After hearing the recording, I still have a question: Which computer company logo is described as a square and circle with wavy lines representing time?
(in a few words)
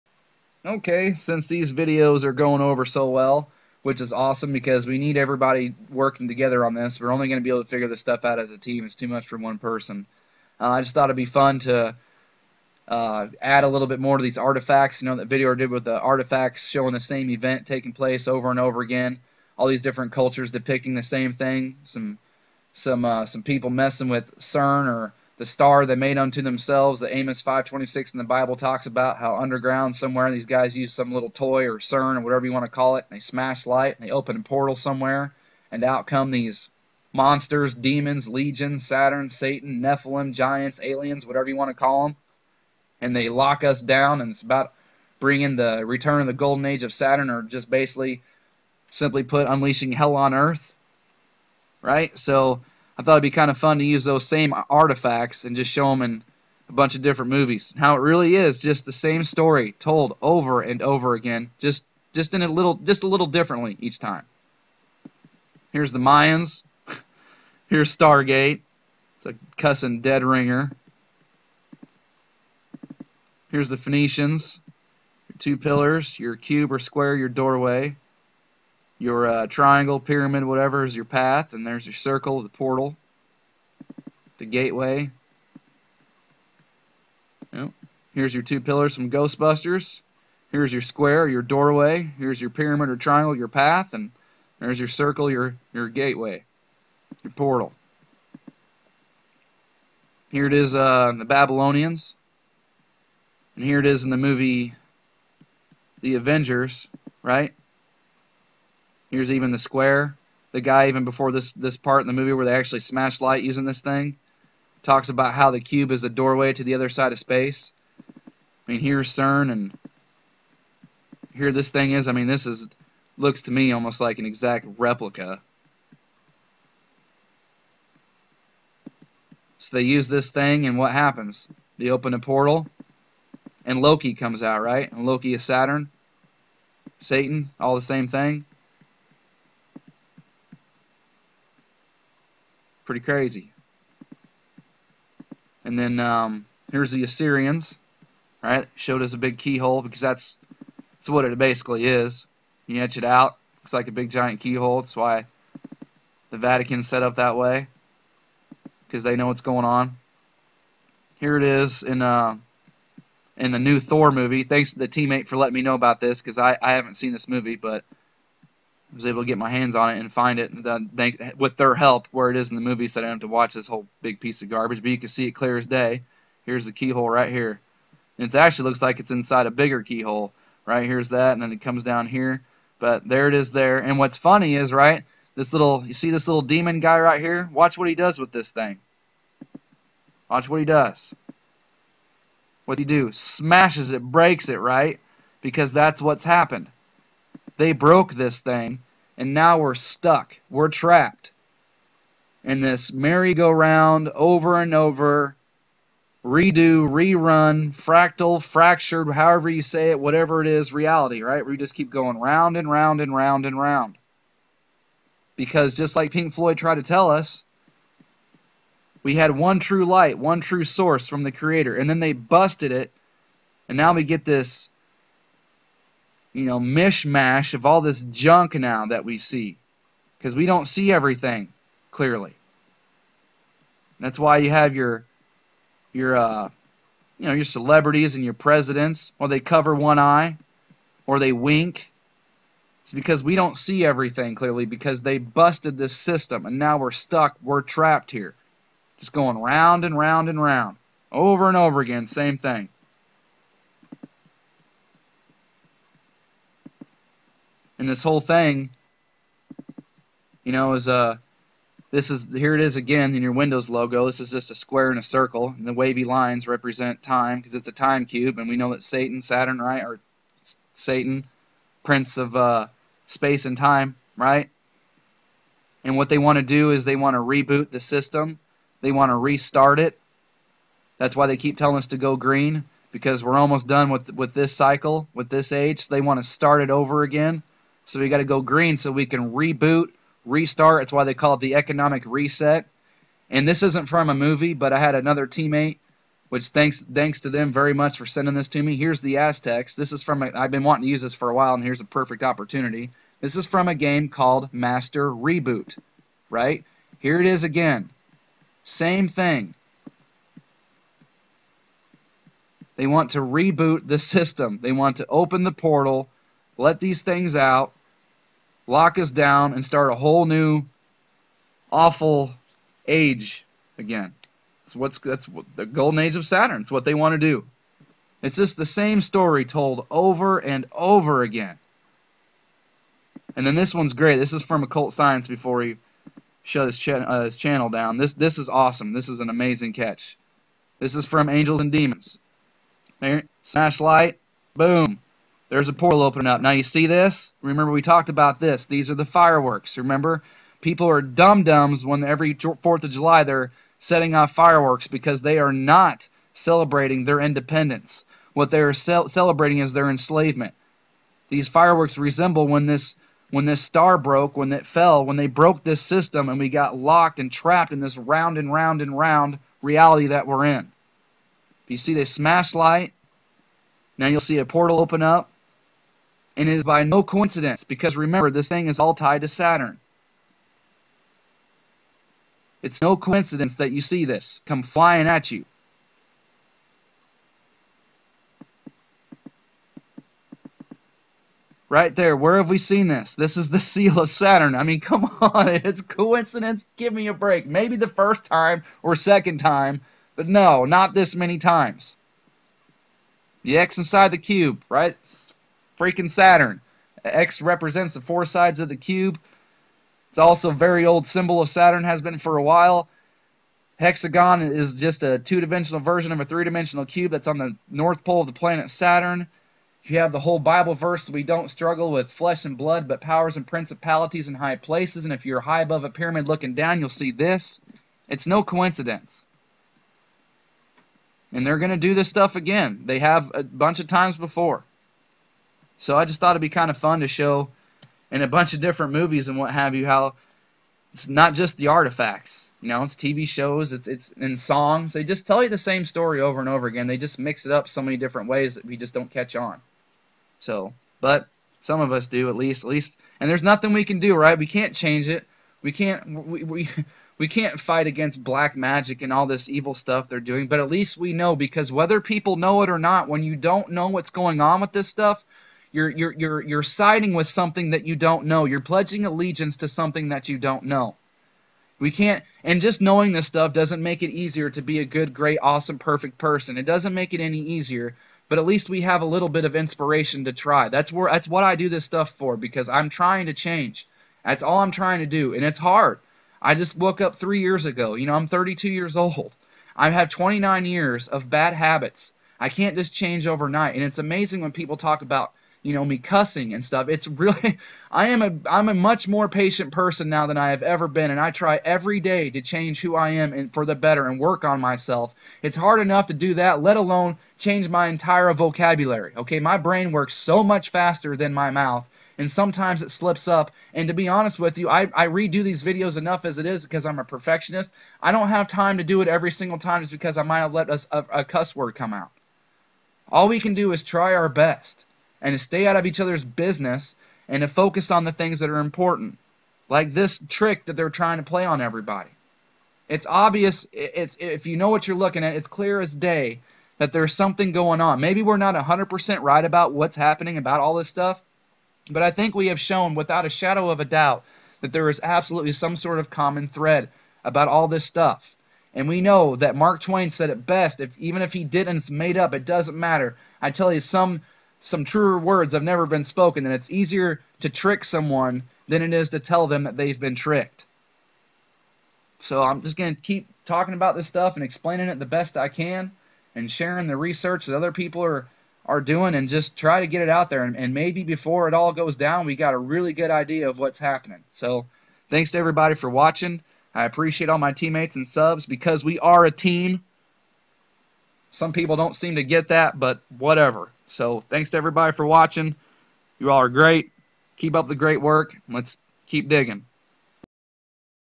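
Windows.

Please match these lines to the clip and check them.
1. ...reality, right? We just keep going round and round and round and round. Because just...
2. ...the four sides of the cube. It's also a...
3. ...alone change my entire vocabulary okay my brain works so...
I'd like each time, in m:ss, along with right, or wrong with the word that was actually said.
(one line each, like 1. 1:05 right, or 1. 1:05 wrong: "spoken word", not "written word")
1. 3:30 right
2. 6:47 right
3. 8:26 right.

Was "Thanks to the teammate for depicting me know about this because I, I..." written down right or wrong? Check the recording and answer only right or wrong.
wrong.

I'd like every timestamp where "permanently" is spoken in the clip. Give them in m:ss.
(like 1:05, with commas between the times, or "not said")
not said.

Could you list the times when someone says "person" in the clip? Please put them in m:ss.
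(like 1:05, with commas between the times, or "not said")
0:09, 7:56, 8:19.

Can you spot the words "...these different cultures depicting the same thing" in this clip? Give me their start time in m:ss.
0:19.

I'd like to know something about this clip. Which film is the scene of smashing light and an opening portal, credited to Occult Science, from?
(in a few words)
Angels and Demons.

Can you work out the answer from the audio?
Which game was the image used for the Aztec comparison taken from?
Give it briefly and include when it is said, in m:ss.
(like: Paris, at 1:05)
Master Reboot, at 5:04.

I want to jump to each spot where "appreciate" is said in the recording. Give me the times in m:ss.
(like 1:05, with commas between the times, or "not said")
9:36.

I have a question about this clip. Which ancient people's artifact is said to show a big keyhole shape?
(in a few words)
Assyrians.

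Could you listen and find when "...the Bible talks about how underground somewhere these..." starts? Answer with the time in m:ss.
0:28.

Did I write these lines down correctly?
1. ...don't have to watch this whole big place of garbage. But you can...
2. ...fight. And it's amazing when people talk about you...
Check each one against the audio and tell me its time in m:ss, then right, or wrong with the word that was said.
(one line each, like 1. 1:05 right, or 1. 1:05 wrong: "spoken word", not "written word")
1. 2:53 wrong: "piece", not "place"
2. 8:13 wrong: "overnight", not "fight".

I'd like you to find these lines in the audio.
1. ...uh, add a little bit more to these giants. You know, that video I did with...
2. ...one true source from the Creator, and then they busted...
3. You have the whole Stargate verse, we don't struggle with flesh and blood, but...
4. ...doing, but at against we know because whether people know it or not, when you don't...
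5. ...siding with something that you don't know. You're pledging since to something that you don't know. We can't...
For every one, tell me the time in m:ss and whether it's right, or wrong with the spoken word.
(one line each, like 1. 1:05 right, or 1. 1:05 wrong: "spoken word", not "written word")
1. 0:12 wrong: "artifacts", not "giants"
2. 3:40 right
3. 6:59 wrong: "Bible", not "Stargate"
4. 7:40 wrong: "least", not "against"
5. 7:46 wrong: "allegiance", not "since".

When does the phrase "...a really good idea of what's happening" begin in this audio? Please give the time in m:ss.
9:32.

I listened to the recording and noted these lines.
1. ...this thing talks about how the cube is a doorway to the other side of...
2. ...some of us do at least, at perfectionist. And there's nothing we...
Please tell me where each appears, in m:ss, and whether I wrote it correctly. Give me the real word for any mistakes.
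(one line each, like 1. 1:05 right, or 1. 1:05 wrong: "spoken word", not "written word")
1. 1:53 right
2. 7:31 wrong: "least", not "perfectionist".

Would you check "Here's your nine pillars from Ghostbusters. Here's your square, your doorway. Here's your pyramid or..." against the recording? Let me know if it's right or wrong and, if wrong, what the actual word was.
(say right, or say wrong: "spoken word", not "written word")
wrong: "two", not "nine".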